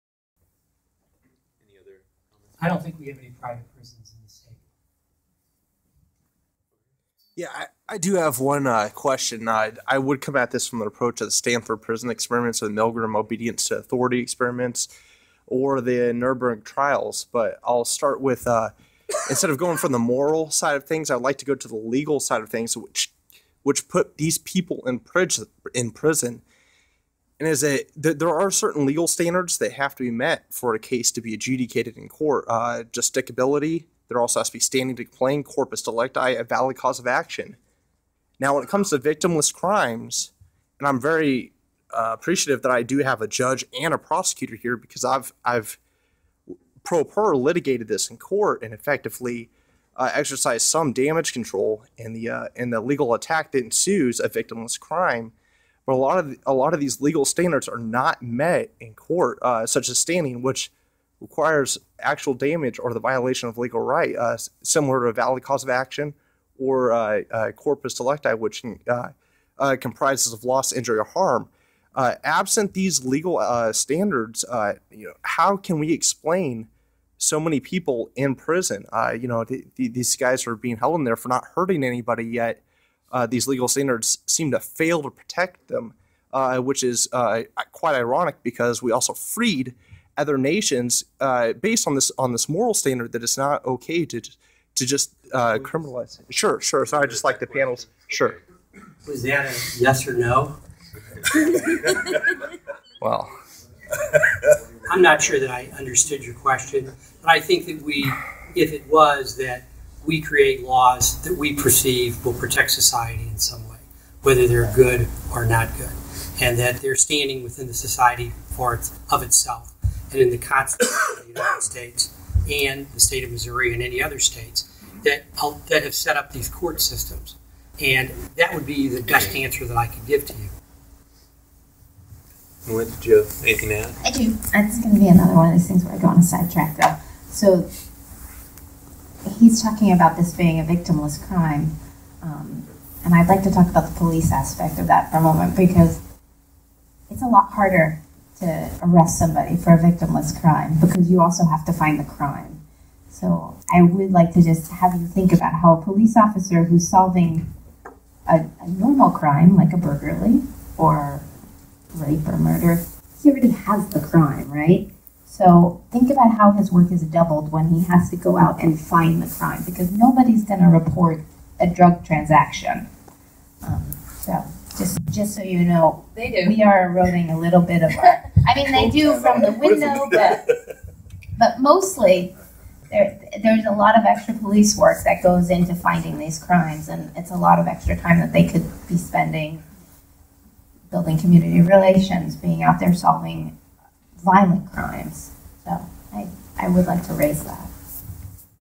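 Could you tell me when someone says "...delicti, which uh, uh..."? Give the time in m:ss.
1:07.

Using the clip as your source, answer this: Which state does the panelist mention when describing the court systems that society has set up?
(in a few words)
Missouri.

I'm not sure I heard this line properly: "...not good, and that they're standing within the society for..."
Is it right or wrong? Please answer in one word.
right.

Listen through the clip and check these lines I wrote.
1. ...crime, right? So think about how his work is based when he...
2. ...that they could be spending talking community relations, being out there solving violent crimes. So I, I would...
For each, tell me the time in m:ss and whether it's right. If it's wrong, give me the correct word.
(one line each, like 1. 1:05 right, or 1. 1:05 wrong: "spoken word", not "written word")
1. 2:43 wrong: "doubled", not "based"
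2. 3:08 wrong: "building", not "talking".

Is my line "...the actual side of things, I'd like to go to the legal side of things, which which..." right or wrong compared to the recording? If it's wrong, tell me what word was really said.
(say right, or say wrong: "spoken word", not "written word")
wrong: "moral", not "actual".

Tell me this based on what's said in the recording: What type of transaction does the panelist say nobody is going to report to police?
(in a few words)
drug transaction.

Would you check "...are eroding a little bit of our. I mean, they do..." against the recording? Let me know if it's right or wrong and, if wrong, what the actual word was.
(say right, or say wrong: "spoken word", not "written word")
right.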